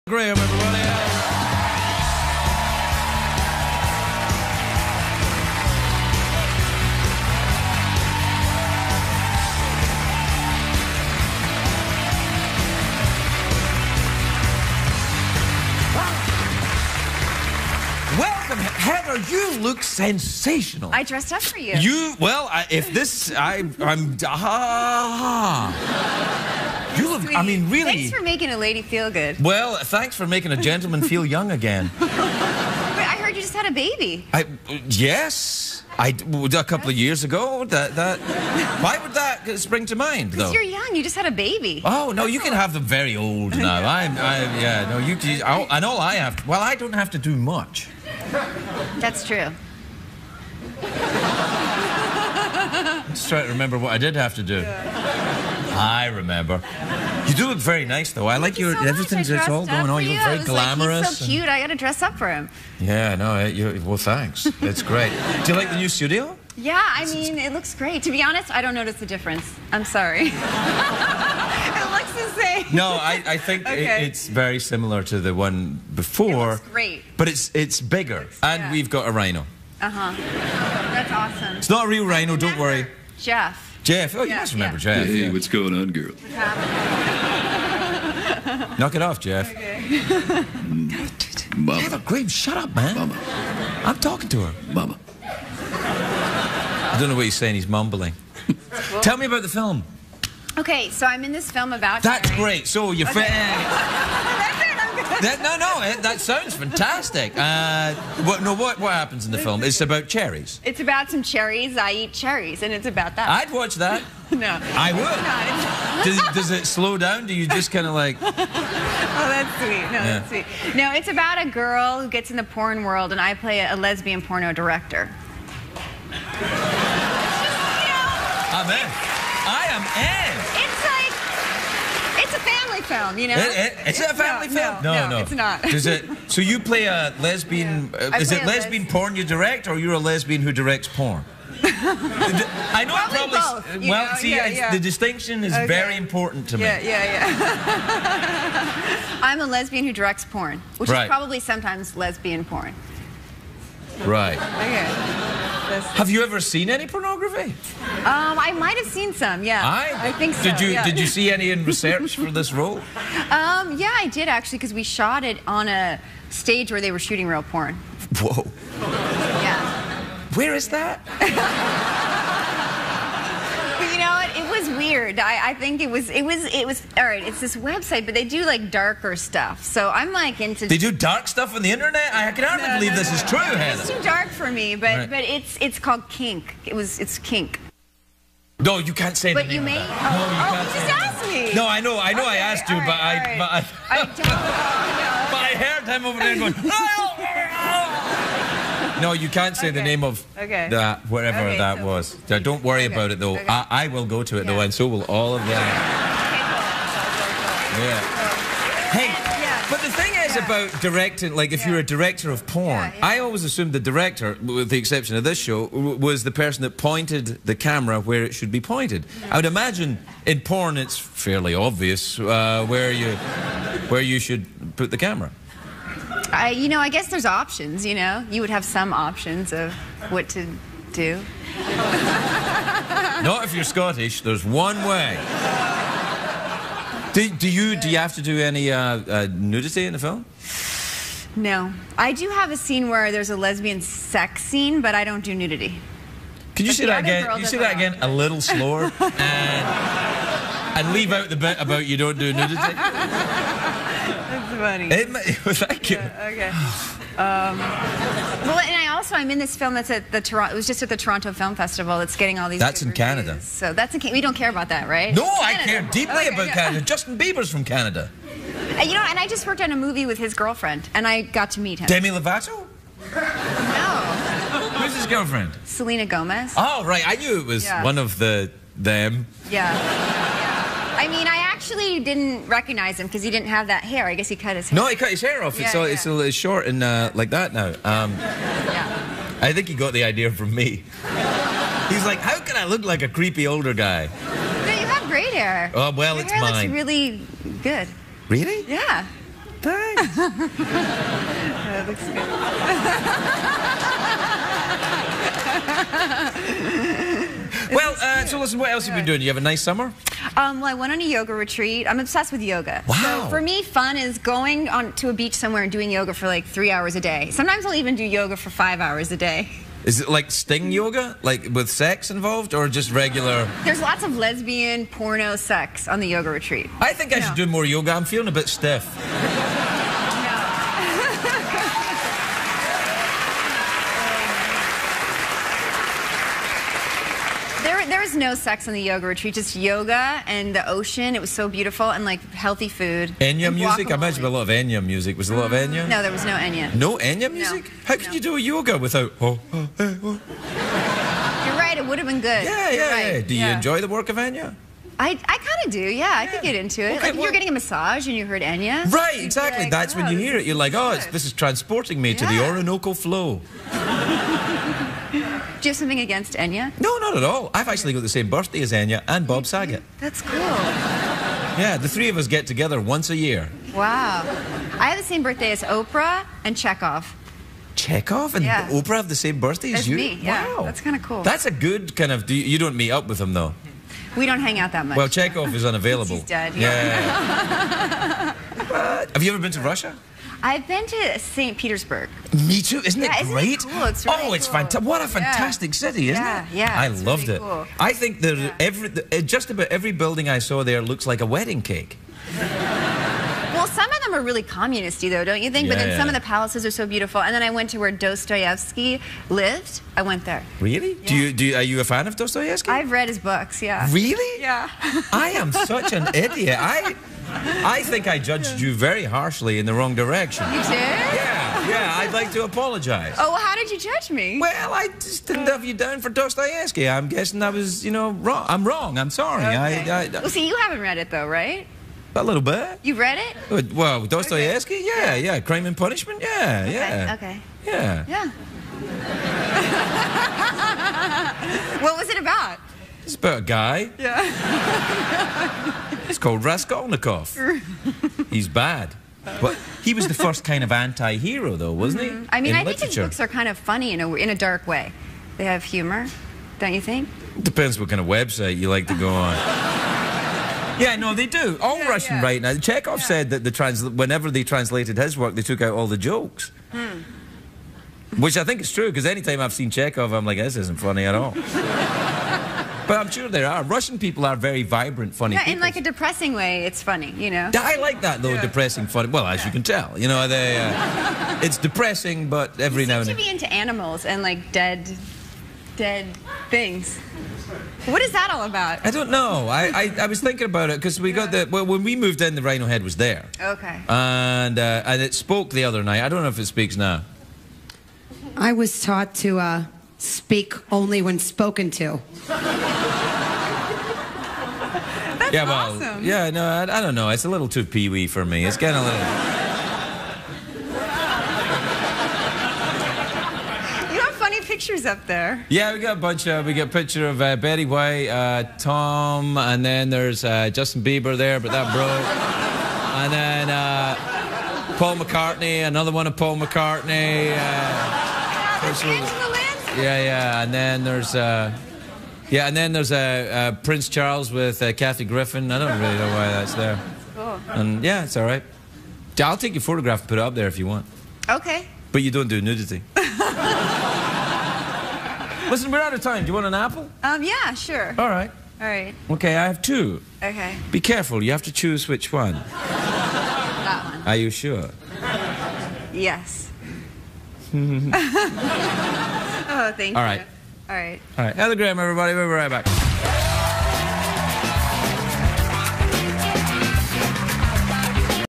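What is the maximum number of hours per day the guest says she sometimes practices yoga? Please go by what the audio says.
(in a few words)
5.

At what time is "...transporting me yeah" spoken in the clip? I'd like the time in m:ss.
6:01.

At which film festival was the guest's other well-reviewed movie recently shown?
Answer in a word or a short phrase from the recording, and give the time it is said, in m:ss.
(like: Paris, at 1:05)
Toronto Film Festival, at 4:20.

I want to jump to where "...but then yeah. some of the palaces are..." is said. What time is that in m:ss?
6:45.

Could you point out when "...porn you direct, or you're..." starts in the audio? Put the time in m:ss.
2:18.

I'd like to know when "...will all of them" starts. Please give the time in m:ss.
3:24.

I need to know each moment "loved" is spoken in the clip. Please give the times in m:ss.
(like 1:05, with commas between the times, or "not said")
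6:36.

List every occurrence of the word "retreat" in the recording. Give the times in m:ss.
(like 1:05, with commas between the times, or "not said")
5:11, 5:26, 5:39.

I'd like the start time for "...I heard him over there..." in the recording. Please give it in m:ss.
3:15.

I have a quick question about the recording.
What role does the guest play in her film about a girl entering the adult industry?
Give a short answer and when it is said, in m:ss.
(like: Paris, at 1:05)
Lesbian porno director, at 2:03.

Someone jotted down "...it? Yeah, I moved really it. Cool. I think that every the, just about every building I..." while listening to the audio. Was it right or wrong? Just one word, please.
wrong.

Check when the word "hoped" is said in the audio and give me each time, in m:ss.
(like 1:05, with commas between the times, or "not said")
not said.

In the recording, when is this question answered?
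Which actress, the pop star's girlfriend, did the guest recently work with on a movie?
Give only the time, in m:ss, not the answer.
4:35.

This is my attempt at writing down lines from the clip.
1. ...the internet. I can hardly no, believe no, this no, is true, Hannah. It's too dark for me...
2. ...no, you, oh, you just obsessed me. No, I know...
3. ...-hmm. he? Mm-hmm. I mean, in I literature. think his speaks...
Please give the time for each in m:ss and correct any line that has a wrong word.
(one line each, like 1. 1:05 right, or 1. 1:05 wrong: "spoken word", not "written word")
1. 3:01 right
2. 3:09 wrong: "asked", not "obsessed"
3. 7:32 wrong: "books", not "speaks".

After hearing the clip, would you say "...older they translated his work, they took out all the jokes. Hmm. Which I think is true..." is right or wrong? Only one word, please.
wrong.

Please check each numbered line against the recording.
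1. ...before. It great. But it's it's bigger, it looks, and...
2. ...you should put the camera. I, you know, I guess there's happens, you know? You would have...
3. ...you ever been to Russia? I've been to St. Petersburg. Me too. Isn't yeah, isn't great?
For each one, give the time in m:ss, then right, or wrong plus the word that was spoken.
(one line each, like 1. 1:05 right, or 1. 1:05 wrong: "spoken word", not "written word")
1. 1:15 right
2. 3:44 wrong: "options", not "happens"
3. 6:29 right.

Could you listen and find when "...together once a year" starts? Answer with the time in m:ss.
6:12.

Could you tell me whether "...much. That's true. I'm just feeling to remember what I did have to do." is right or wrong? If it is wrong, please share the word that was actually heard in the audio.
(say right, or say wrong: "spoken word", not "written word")
wrong: "trying", not "feeling".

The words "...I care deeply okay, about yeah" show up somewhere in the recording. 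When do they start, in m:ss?
4:25.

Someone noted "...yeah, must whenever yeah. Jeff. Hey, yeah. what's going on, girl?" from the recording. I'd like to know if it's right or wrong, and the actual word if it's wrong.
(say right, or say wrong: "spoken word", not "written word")
wrong: "remember", not "whenever".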